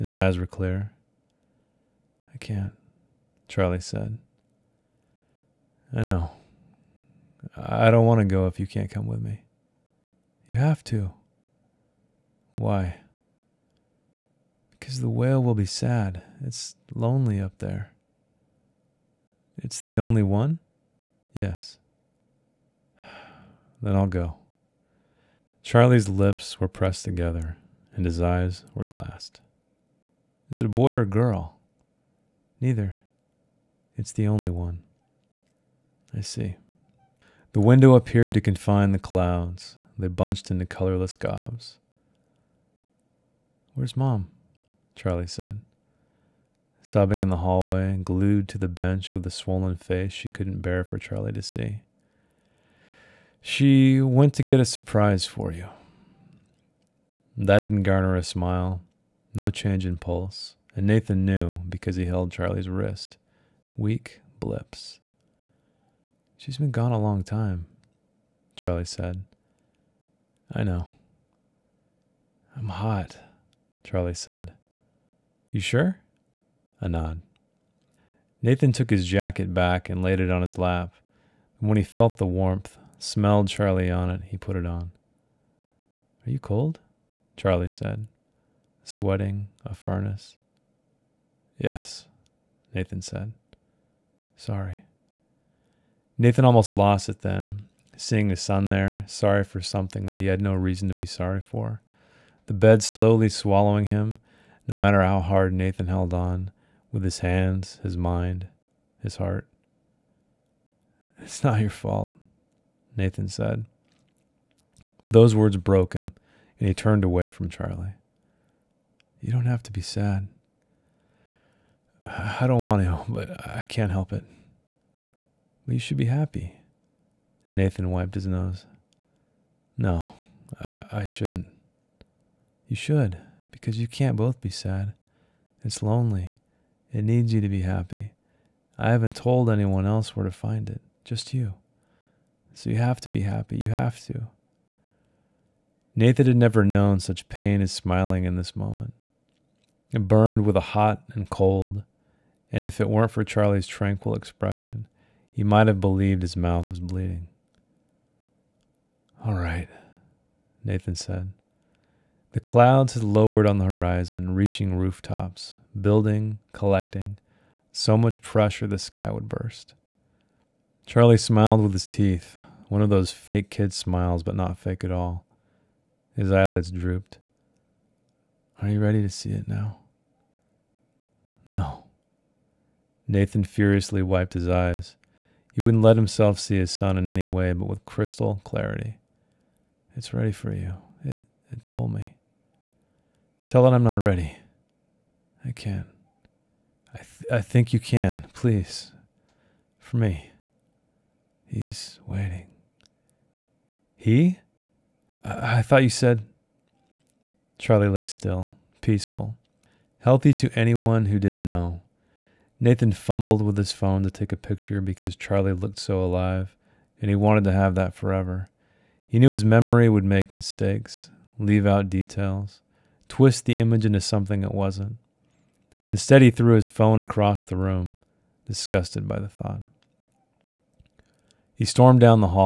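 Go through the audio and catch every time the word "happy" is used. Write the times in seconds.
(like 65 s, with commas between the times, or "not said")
126 s, 137 s, 143 s.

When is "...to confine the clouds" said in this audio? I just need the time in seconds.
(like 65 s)
38 s.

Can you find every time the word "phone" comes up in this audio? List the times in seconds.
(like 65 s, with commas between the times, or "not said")
213 s, 226 s.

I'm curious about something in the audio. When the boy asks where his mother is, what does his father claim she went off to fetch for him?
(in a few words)
a surprise.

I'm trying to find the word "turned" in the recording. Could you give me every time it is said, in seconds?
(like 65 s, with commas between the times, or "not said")
116 s.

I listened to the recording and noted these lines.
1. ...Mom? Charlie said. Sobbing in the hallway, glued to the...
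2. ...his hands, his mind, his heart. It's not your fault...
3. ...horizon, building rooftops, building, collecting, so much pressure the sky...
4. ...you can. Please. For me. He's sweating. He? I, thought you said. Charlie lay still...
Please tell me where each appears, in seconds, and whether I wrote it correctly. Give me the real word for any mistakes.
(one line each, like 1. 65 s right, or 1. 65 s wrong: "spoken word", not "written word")
1. 43 s right
2. 107 s right
3. 163 s wrong: "reaching", not "building"
4. 197 s wrong: "waiting", not "sweating".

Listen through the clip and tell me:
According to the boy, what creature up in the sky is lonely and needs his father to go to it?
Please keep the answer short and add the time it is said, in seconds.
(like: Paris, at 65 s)
whale, at 15 s.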